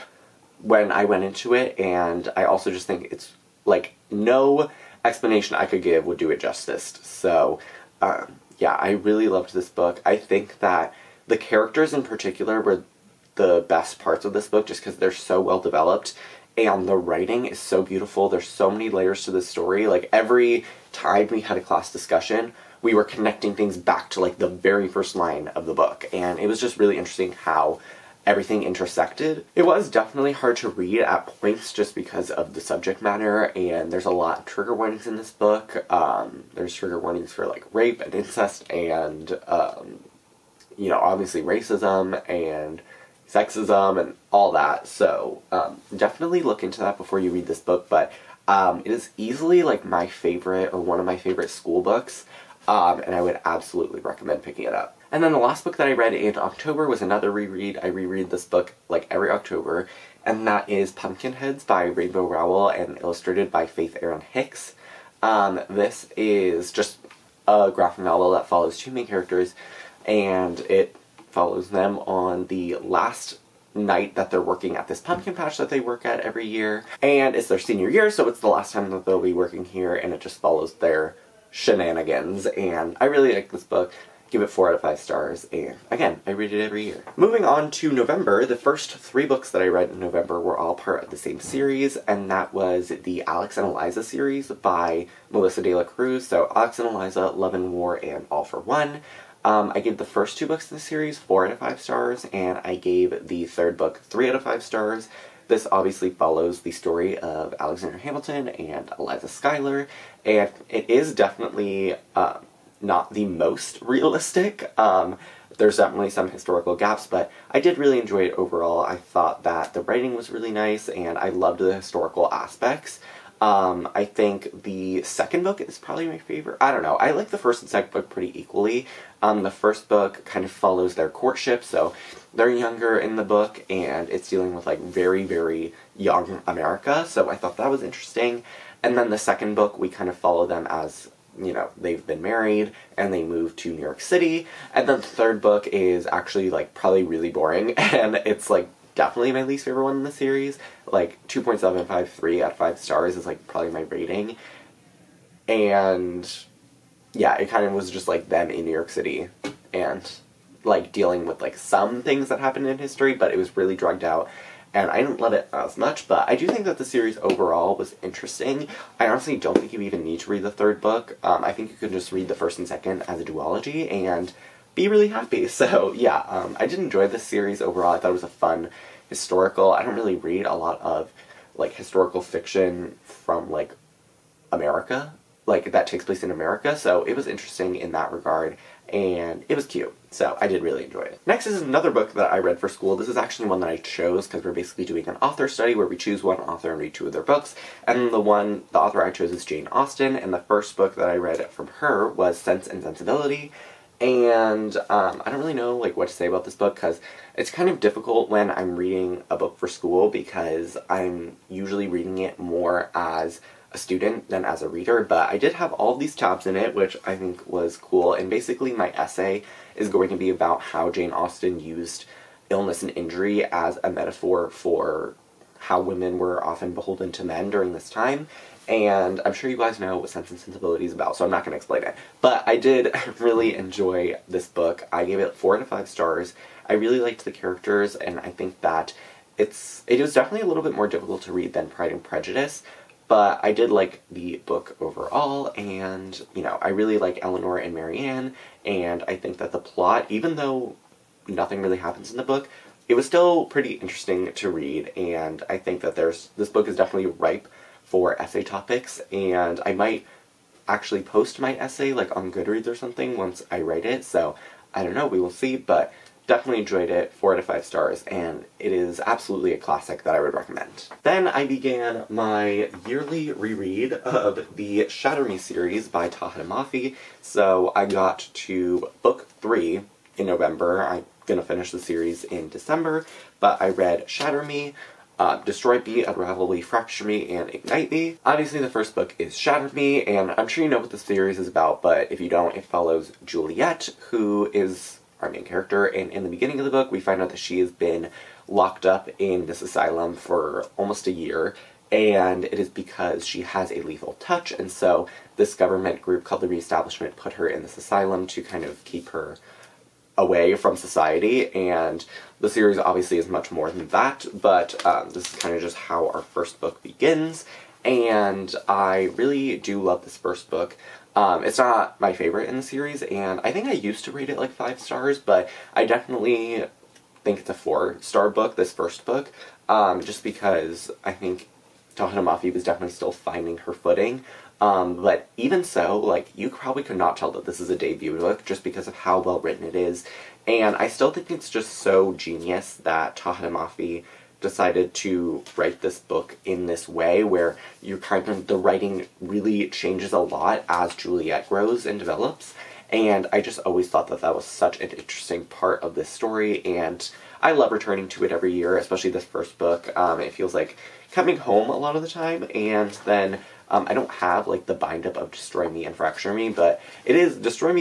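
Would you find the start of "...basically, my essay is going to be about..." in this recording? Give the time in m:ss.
3:38.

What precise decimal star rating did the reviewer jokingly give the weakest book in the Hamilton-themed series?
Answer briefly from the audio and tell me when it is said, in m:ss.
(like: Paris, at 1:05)
2.753, at 2:31.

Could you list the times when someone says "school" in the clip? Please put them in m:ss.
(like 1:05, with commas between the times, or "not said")
0:51, 3:12, 3:29.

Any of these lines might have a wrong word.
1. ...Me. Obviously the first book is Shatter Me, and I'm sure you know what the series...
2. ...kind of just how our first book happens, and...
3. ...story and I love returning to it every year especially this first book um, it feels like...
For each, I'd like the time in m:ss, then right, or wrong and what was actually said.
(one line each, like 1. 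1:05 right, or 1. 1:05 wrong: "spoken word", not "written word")
1. 4:47 right
2. 5:15 wrong: "begins", not "happens"
3. 5:56 right.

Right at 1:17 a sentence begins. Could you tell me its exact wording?
And it's their senior year, so it's the last time that they'll be working here, and it just follows their shenanigans.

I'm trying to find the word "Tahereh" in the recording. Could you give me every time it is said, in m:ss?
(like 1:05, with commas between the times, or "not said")
4:36, 5:31, 5:43.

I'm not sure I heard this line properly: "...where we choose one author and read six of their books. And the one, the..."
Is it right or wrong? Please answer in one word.
wrong.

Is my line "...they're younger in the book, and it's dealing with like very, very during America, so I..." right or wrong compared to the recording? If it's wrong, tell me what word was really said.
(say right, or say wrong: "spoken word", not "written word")
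wrong: "young", not "during".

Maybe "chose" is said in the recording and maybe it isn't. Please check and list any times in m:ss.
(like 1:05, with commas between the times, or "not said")
3:13, 3:19.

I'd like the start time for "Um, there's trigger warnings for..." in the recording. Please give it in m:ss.
0:35.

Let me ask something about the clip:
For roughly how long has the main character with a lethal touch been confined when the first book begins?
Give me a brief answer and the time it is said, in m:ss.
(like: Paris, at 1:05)
Almost a year, at 5:00.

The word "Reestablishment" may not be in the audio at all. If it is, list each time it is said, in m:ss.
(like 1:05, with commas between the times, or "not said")
5:06.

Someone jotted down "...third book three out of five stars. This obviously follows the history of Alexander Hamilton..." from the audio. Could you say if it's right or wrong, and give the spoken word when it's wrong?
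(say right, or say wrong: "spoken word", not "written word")
wrong: "story", not "history".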